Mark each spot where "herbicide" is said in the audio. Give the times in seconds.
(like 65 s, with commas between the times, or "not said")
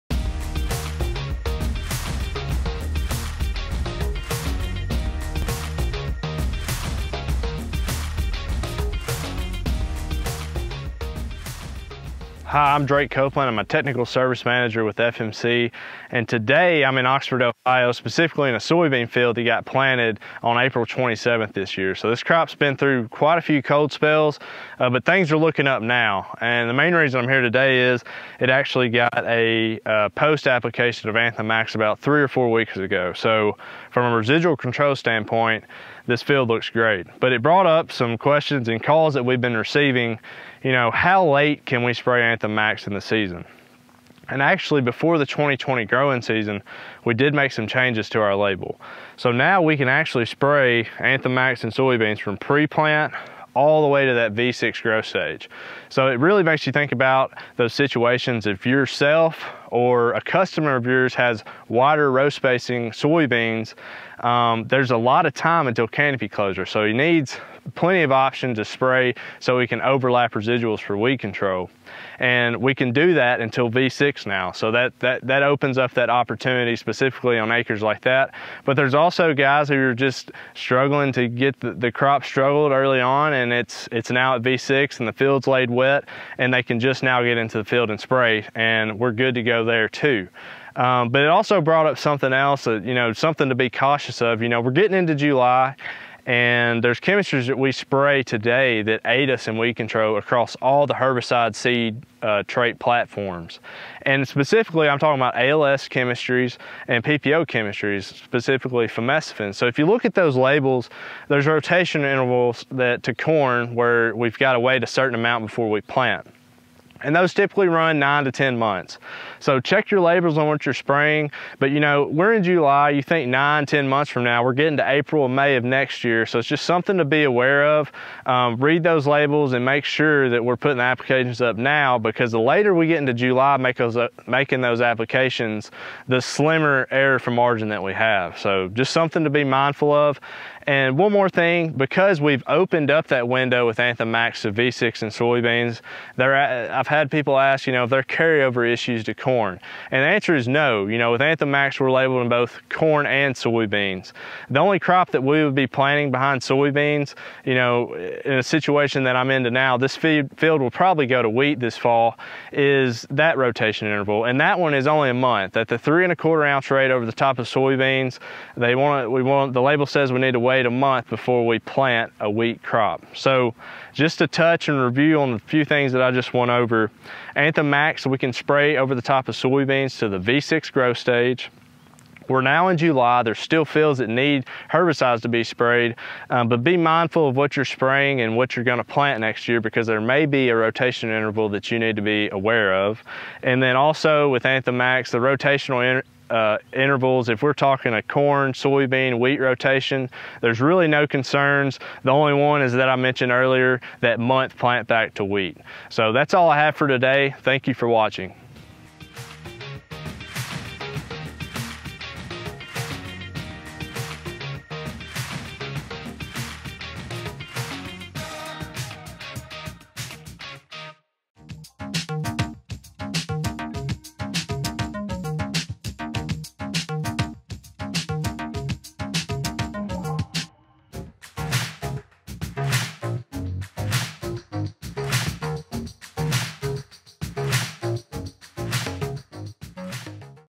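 100 s, 184 s.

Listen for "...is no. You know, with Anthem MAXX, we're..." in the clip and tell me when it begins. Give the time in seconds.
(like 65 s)
150 s.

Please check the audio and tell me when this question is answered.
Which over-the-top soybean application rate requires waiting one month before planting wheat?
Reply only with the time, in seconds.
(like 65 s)
165 s.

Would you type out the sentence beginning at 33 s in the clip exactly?
So from a residual control standpoint, this field looks great.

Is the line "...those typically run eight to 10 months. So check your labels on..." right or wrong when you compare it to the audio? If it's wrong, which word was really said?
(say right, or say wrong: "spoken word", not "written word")
wrong: "nine", not "eight".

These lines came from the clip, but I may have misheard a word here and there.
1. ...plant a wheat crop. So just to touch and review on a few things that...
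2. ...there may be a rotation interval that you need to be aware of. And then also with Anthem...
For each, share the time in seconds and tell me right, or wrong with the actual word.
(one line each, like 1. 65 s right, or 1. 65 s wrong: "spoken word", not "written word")
1. 171 s right
2. 189 s right.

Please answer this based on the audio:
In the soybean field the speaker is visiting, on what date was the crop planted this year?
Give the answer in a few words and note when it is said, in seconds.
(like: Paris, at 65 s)
April 27, at 20 s.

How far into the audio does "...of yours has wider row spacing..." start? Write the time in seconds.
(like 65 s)
60 s.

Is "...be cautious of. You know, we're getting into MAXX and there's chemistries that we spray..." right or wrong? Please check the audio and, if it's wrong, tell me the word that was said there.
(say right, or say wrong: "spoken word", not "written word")
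wrong: "July", not "MAXX".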